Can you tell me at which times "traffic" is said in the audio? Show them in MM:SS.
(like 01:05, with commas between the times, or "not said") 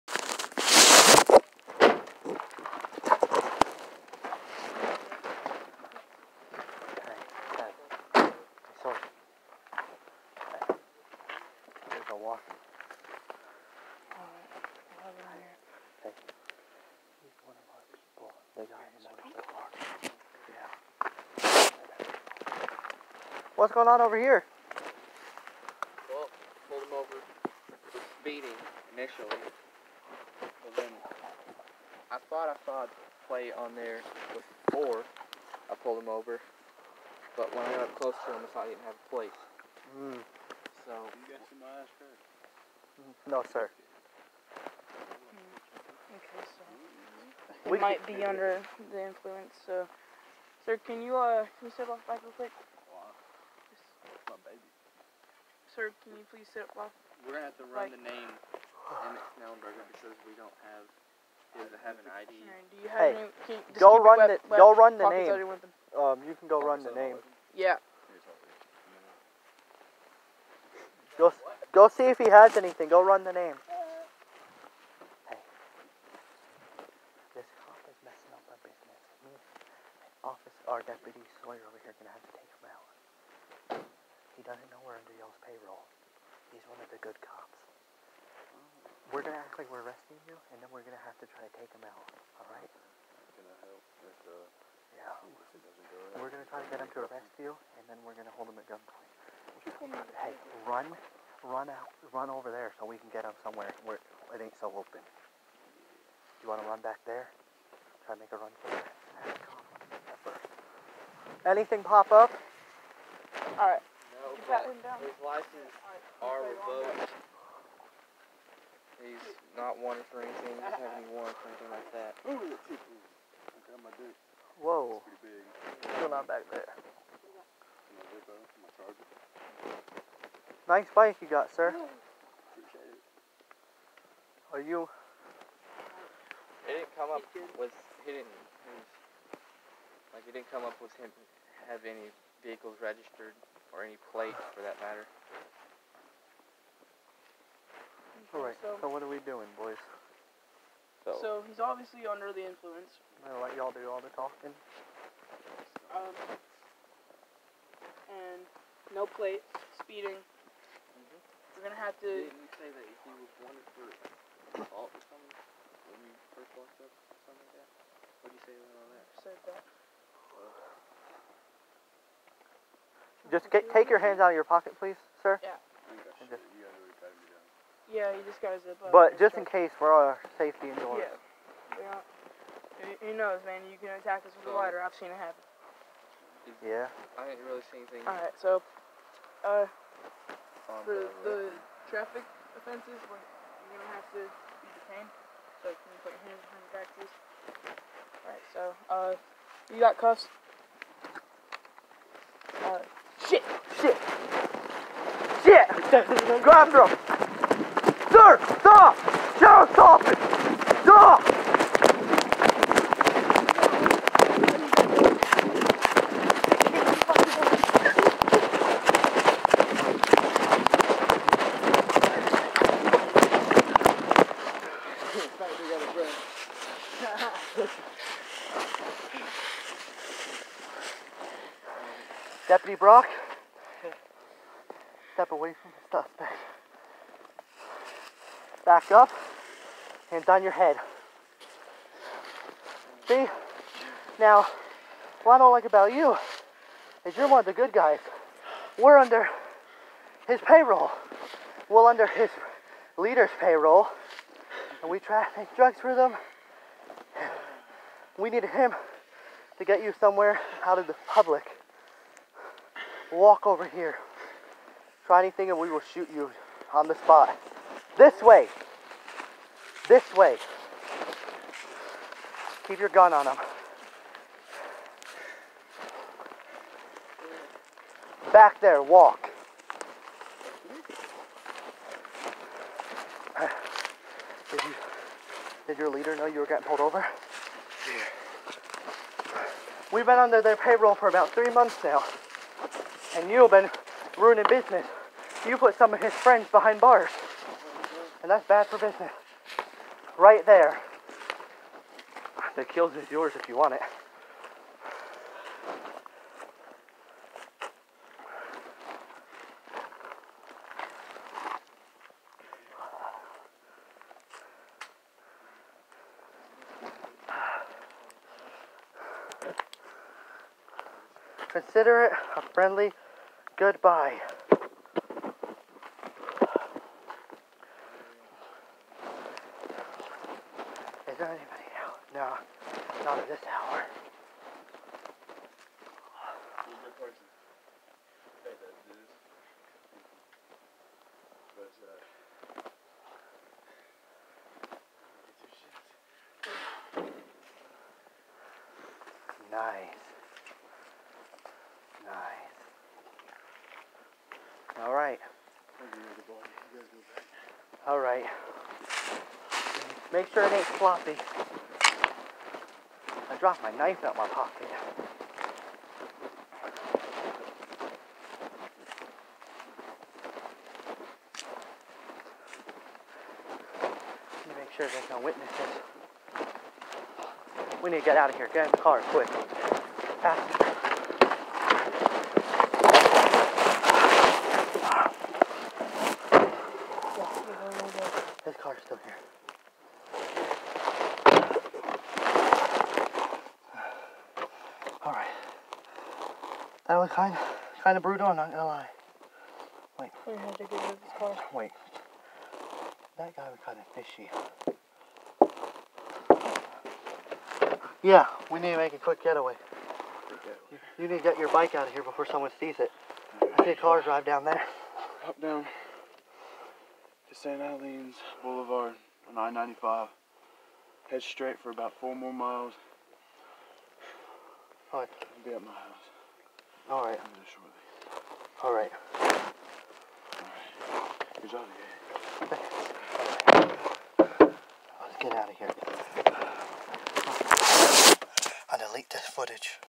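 03:11, 04:14.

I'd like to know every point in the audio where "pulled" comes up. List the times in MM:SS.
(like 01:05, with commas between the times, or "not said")
00:26, 00:35, 04:46.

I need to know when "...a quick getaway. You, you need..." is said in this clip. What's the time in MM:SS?
06:48.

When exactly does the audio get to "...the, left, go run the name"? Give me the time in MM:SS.
01:04.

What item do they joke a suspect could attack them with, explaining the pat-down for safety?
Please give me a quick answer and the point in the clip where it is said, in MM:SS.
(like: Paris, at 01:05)
a lighter, at 03:04.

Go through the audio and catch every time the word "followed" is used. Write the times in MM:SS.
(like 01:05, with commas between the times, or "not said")
not said.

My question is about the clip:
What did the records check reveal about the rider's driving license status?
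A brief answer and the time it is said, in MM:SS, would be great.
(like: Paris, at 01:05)
revoked, at 01:56.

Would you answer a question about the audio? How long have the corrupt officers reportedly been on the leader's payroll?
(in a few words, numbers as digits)
about three months.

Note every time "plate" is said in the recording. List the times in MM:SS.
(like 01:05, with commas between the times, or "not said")
00:33, 00:39, 02:24, 02:39.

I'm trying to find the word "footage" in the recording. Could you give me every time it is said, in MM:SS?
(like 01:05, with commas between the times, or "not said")
07:19.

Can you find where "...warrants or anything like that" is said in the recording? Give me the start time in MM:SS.
02:01.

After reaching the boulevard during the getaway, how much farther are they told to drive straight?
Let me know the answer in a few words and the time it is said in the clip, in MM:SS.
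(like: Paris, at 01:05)
4 more miles, at 07:01.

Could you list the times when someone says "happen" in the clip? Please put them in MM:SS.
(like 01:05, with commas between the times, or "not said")
03:05.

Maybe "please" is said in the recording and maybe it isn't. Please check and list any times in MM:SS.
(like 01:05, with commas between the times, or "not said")
00:56, 02:54, 03:16.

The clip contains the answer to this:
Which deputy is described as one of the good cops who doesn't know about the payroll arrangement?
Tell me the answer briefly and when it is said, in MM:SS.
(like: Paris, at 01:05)
Deputy Sawyer, at 01:20.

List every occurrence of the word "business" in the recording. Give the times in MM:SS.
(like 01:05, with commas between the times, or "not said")
01:18, 04:54, 04:58.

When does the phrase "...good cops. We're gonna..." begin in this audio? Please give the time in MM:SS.
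01:26.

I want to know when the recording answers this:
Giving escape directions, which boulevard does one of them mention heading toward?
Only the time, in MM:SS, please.
06:57.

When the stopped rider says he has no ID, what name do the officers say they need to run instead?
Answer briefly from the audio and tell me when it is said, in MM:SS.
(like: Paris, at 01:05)
Emmett Snellenberger, at 00:58.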